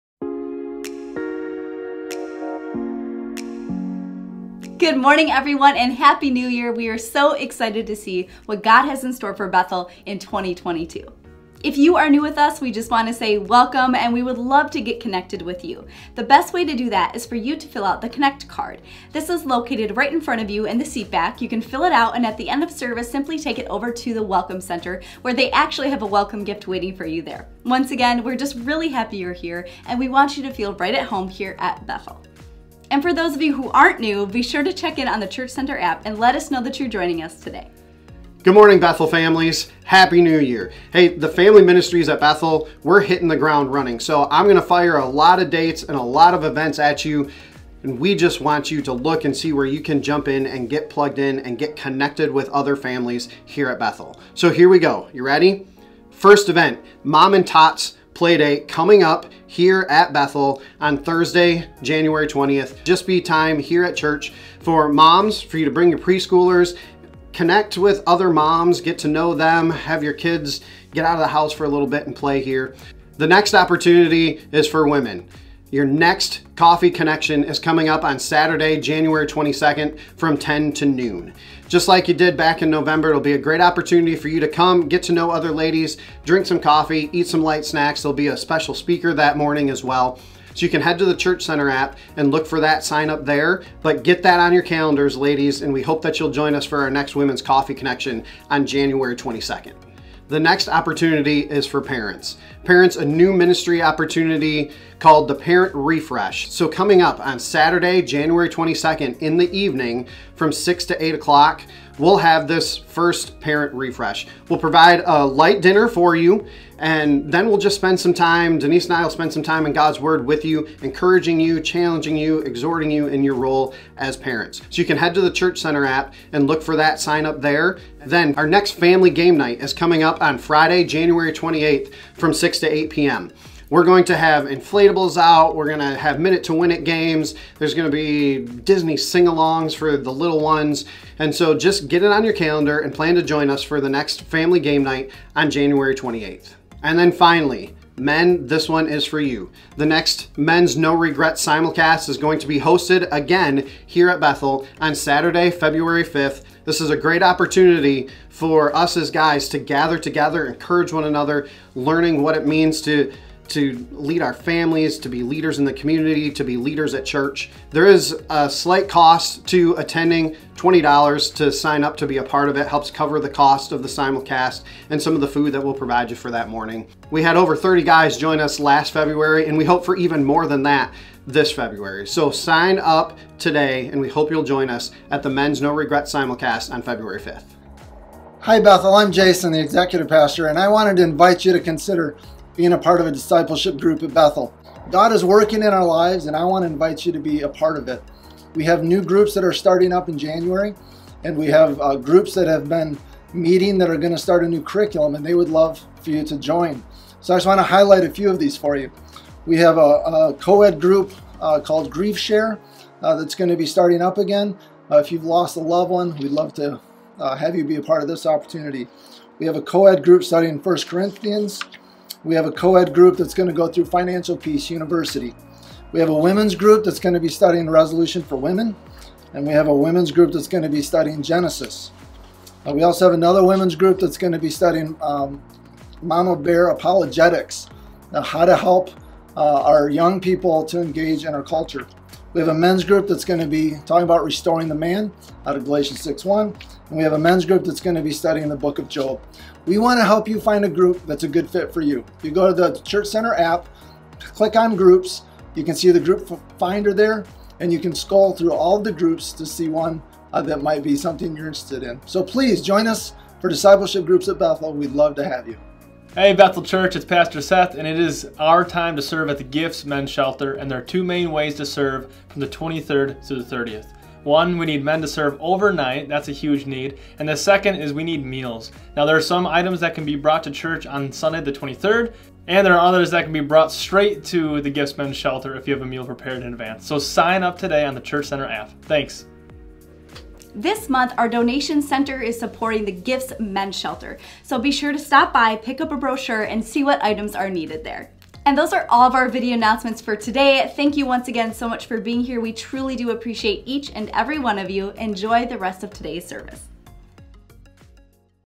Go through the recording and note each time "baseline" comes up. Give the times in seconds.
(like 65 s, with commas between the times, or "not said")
not said.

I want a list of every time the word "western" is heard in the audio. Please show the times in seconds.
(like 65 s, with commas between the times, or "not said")
not said.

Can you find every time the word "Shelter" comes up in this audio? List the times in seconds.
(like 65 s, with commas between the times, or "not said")
270 s, 285 s, 293 s.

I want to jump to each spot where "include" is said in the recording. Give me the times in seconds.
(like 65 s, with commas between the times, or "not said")
not said.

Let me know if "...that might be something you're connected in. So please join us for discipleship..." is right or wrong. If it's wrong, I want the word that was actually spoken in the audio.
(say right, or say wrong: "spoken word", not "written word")
wrong: "interested", not "connected".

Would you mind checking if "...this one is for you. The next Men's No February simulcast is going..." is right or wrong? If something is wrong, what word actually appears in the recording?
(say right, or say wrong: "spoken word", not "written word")
wrong: "Regret", not "February".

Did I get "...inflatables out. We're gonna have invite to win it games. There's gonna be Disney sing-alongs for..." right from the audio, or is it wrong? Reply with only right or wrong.
wrong.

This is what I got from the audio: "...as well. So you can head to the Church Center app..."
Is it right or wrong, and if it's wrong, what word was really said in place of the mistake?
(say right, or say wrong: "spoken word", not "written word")
right.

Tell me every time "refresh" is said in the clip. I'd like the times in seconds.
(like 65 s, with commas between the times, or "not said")
105 s, 113 s.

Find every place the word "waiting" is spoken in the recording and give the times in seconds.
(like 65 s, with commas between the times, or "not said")
26 s.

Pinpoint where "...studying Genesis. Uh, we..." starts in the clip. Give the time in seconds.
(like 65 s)
230 s.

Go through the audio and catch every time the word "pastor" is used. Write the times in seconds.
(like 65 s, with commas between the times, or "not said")
190 s, 267 s.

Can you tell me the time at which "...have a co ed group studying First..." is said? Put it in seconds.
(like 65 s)
219 s.